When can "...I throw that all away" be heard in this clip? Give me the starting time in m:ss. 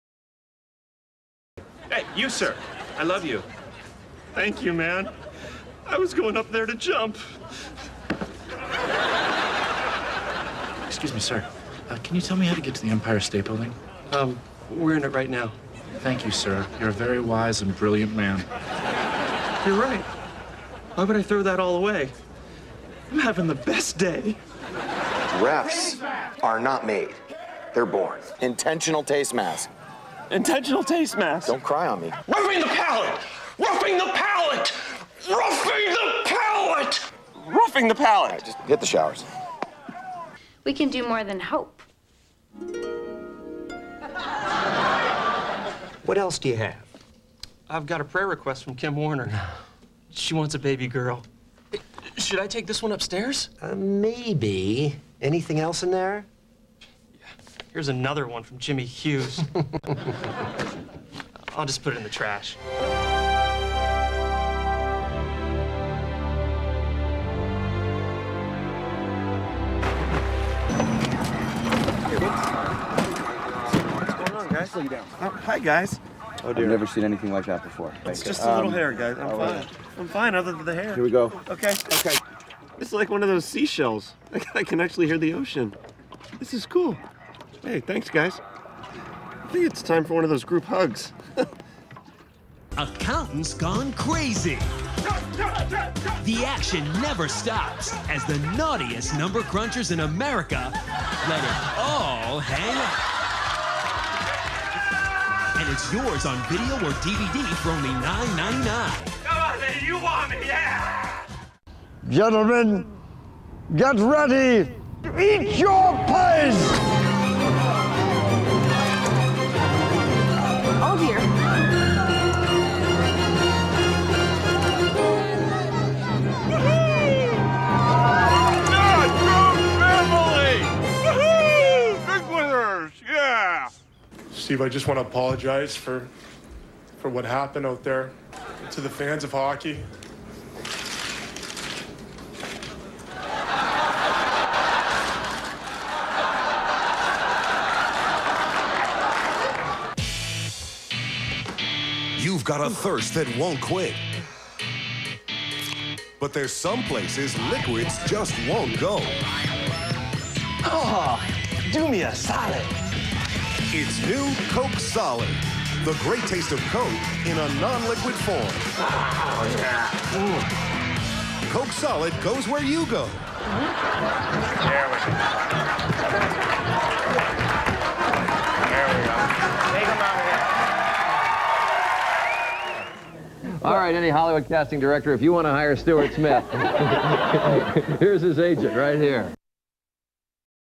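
0:21.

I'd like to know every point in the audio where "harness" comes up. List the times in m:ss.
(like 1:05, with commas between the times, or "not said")
not said.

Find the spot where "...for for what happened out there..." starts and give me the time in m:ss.
2:15.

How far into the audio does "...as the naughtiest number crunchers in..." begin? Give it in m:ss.
1:38.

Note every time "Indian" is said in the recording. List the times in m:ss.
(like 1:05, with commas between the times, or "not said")
not said.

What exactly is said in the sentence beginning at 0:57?
Here's another one from Jimmy Hughes.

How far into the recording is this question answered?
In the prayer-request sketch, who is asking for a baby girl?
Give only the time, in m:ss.
0:48.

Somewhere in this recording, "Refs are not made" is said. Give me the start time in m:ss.
0:25.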